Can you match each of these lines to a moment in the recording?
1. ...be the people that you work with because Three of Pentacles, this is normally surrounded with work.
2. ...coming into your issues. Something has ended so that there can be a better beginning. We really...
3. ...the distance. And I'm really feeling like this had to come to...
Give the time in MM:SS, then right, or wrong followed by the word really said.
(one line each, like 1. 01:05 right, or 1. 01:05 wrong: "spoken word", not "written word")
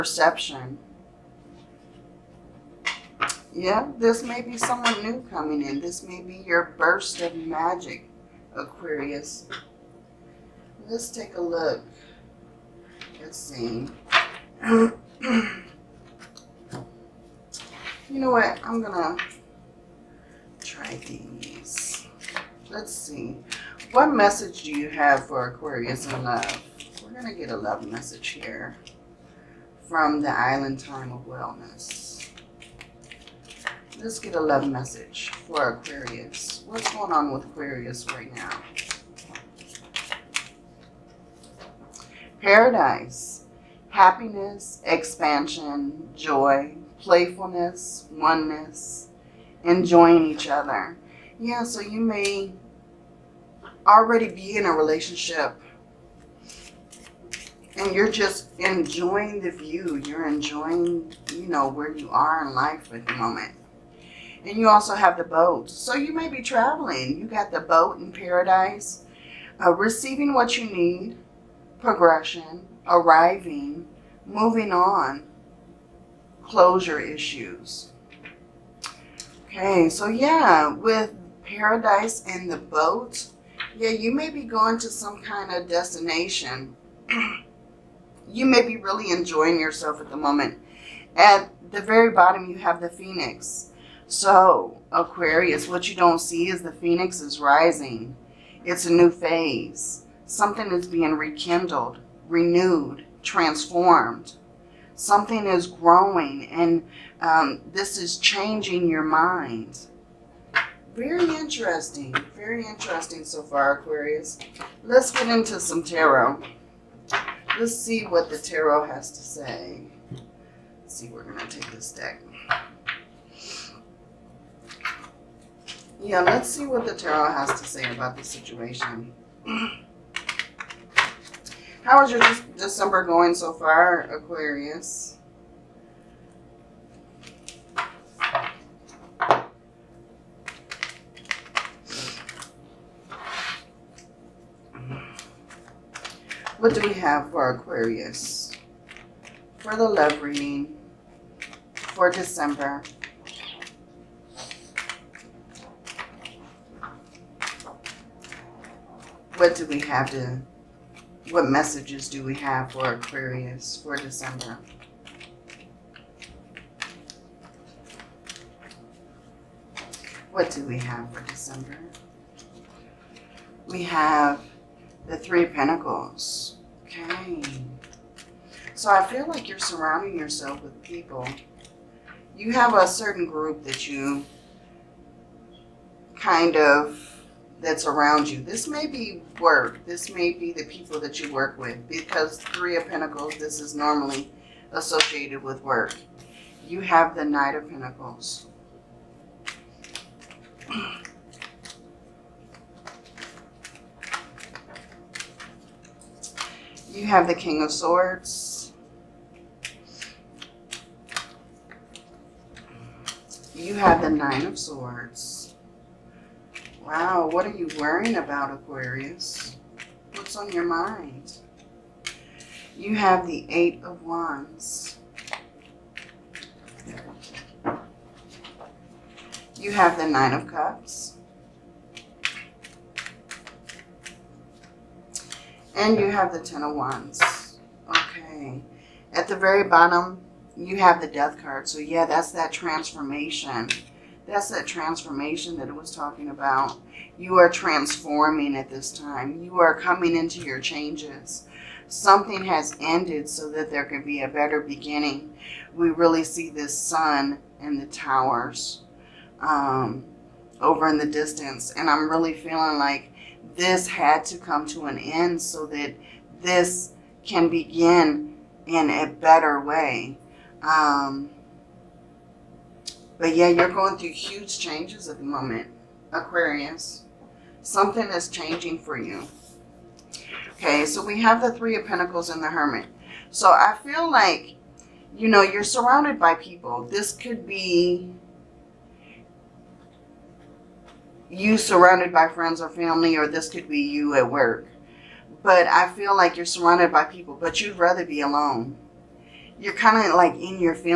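1. 03:10 wrong: "associated", not "surrounded"
2. 04:09 wrong: "changes", not "issues"
3. 04:20 right.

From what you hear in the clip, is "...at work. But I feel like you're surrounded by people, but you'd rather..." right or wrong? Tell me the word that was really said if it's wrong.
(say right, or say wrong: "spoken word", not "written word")
right.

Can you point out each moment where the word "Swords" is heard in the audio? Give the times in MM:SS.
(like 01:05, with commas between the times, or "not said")
03:27, 03:34.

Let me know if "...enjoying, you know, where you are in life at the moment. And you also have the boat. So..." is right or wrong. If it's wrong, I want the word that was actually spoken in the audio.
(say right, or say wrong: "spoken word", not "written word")
right.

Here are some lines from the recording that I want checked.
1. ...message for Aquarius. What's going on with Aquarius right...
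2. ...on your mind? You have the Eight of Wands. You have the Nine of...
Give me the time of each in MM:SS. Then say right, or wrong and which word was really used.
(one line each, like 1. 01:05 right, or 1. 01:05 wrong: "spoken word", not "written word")
1. 00:34 right
2. 03:40 right.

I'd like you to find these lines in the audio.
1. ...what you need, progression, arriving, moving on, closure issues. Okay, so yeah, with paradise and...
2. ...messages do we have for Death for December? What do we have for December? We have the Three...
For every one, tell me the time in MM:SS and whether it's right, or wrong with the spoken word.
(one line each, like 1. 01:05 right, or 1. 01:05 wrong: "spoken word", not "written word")
1. 01:10 right
2. 02:41 wrong: "Aquarius", not "Death".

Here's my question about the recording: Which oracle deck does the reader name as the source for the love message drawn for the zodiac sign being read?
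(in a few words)
Island Time of Wellness.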